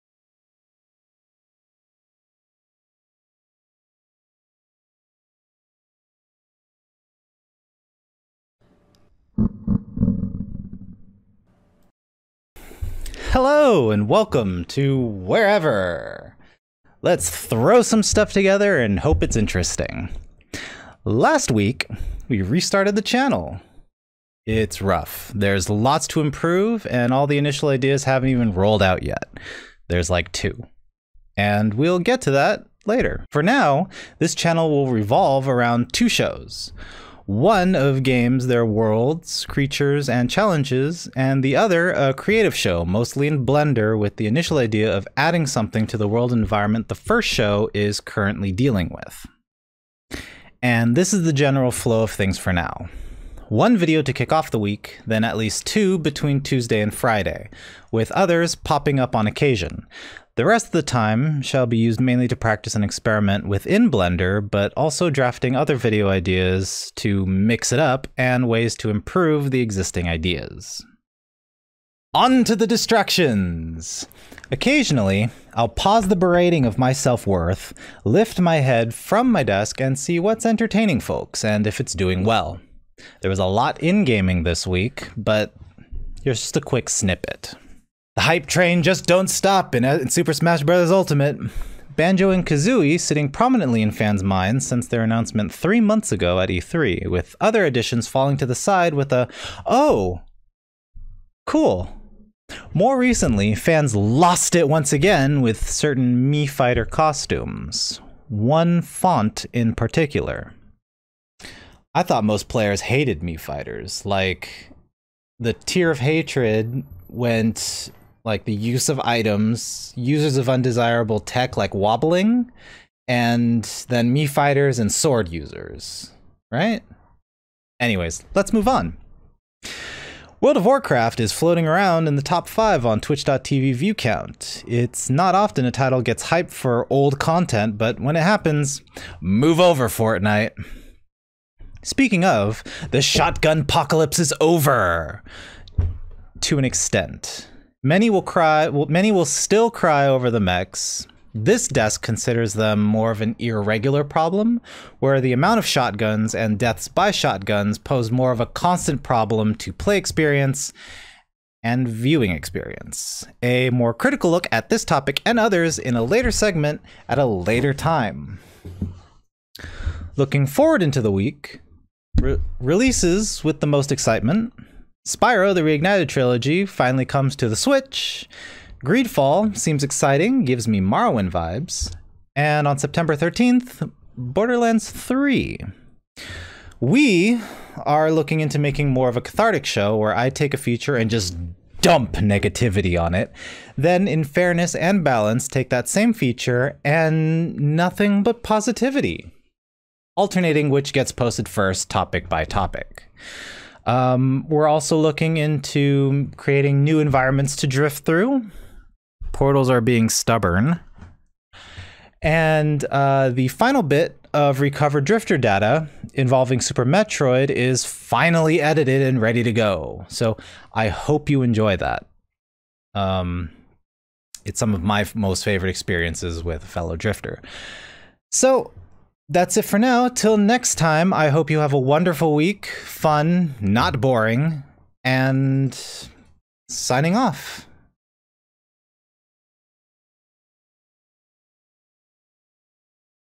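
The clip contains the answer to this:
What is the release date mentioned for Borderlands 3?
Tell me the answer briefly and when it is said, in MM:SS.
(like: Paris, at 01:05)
September 13th, at 03:02.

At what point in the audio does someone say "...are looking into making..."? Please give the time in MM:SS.
03:07.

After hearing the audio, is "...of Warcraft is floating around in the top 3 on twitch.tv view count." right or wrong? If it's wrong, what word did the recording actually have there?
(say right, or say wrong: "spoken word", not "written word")
wrong: "5", not "3".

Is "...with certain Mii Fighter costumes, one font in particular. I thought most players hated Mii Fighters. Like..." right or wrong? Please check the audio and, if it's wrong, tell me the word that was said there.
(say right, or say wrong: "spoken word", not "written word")
right.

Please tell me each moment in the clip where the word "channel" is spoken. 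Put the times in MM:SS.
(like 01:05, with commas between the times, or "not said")
00:23, 00:34.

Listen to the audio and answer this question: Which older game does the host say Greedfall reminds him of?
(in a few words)
Morrowind.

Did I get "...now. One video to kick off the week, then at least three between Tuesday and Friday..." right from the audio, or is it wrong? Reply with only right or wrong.
wrong.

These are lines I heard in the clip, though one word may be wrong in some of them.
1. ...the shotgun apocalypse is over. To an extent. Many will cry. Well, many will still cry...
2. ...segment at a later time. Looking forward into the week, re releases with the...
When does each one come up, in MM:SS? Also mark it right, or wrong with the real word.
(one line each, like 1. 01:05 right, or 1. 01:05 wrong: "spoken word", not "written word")
1. 02:22 right
2. 02:46 right.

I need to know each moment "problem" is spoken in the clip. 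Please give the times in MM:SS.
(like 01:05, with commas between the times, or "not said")
02:34, 02:39.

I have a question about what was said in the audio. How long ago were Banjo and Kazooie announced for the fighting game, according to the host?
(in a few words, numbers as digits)
3 months.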